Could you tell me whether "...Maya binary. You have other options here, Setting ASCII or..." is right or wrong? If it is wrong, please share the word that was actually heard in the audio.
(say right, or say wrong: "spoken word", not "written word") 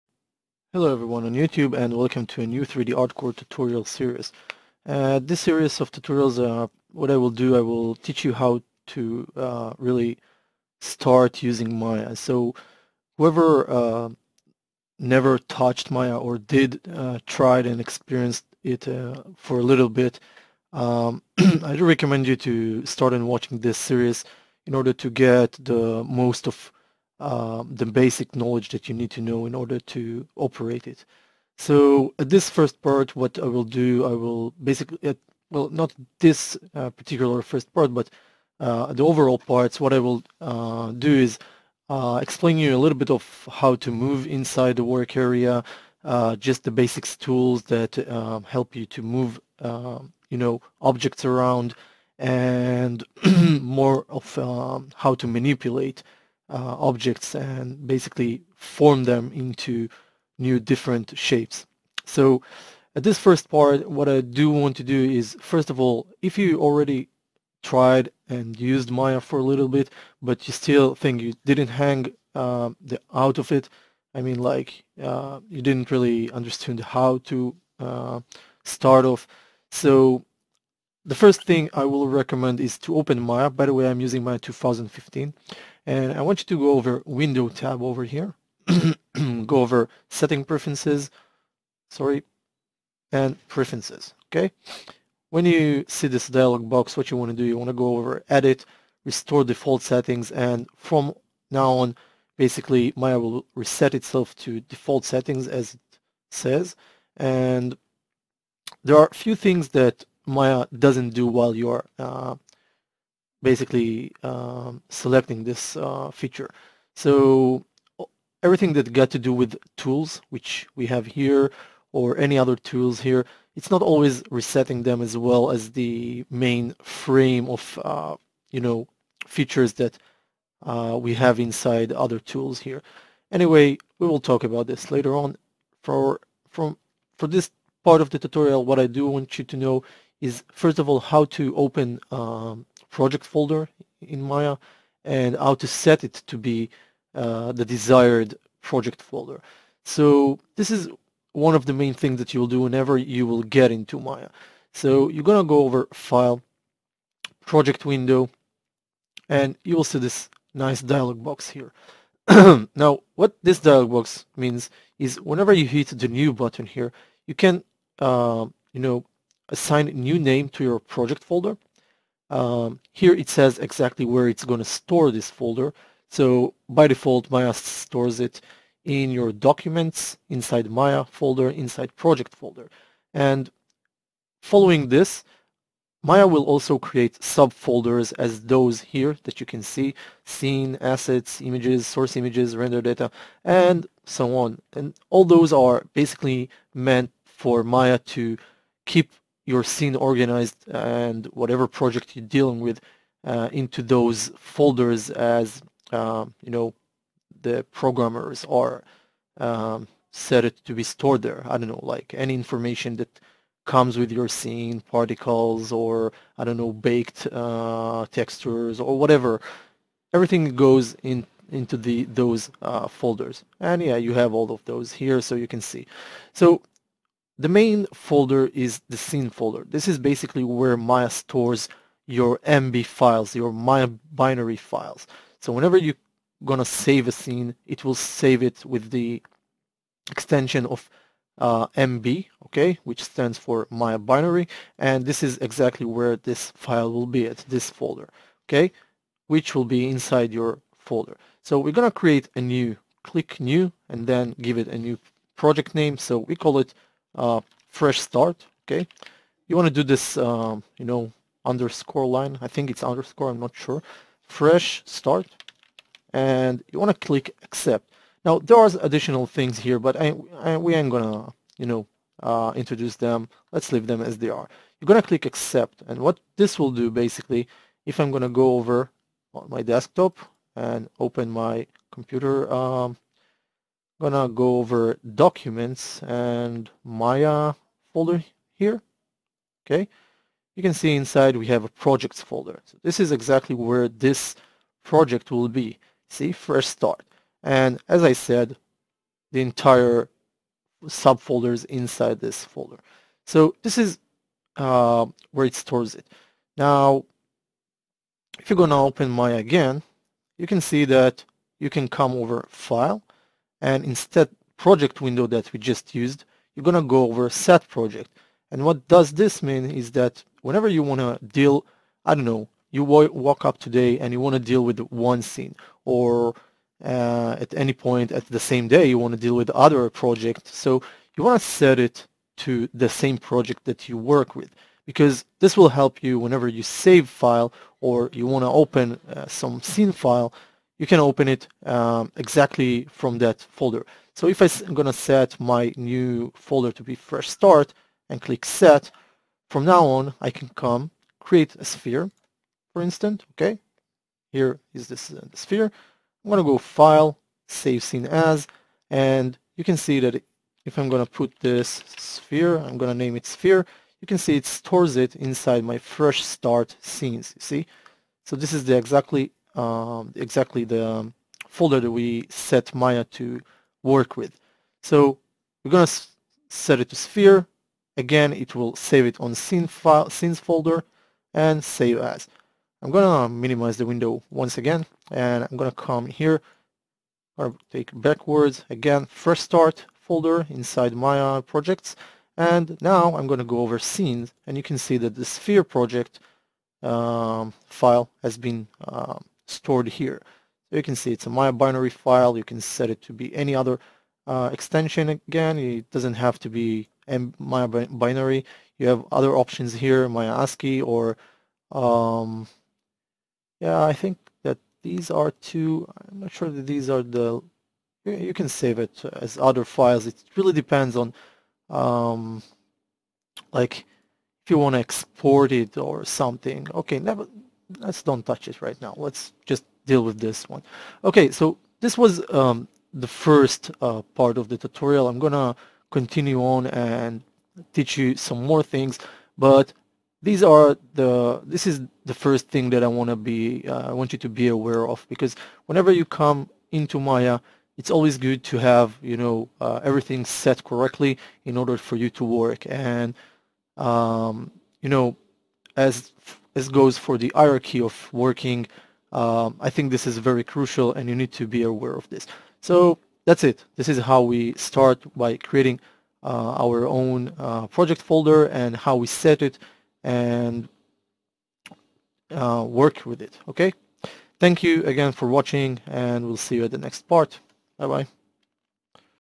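wrong: "Maya", not "Setting".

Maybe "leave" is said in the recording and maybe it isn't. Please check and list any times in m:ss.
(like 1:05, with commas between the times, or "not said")
4:33.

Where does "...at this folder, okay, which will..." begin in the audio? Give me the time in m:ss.
4:07.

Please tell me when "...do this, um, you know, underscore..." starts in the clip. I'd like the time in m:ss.
4:19.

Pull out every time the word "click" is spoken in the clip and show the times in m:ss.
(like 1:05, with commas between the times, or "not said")
4:13, 4:27, 4:35, 5:48.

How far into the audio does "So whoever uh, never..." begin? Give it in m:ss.
0:12.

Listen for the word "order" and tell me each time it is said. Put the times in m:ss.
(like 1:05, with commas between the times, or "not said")
0:24, 0:29, 7:31.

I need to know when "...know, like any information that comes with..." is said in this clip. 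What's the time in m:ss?
3:31.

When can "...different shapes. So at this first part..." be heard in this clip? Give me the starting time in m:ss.
1:00.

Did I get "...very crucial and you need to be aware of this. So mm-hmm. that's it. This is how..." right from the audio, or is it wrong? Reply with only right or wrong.
right.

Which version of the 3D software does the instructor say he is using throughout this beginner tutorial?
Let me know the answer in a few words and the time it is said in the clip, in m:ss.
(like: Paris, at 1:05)
Maya 2015, at 1:24.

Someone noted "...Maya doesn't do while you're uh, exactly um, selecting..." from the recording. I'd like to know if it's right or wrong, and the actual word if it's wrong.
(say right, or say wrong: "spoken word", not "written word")
wrong: "basically", not "exactly".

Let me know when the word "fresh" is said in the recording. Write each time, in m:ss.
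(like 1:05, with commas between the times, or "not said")
4:17, 4:24, 4:56, 5:46, 6:05.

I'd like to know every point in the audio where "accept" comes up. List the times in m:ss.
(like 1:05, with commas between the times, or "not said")
4:27, 4:35.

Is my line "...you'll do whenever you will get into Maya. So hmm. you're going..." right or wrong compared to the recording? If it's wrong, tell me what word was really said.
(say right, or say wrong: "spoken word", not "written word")
right.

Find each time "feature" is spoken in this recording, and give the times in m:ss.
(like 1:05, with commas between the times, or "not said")
1:56, 2:09.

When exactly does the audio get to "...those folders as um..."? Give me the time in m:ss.
3:23.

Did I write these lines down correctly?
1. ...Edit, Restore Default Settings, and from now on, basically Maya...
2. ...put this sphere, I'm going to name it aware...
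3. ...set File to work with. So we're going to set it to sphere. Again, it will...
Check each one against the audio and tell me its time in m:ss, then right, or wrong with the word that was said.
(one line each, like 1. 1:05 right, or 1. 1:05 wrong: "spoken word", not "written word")
1. 1:38 right
2. 6:01 wrong: "sphere", not "aware"
3. 6:12 wrong: "Maya", not "File".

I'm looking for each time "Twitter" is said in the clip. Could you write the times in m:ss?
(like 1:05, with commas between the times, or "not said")
not said.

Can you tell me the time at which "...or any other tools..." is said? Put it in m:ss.
2:01.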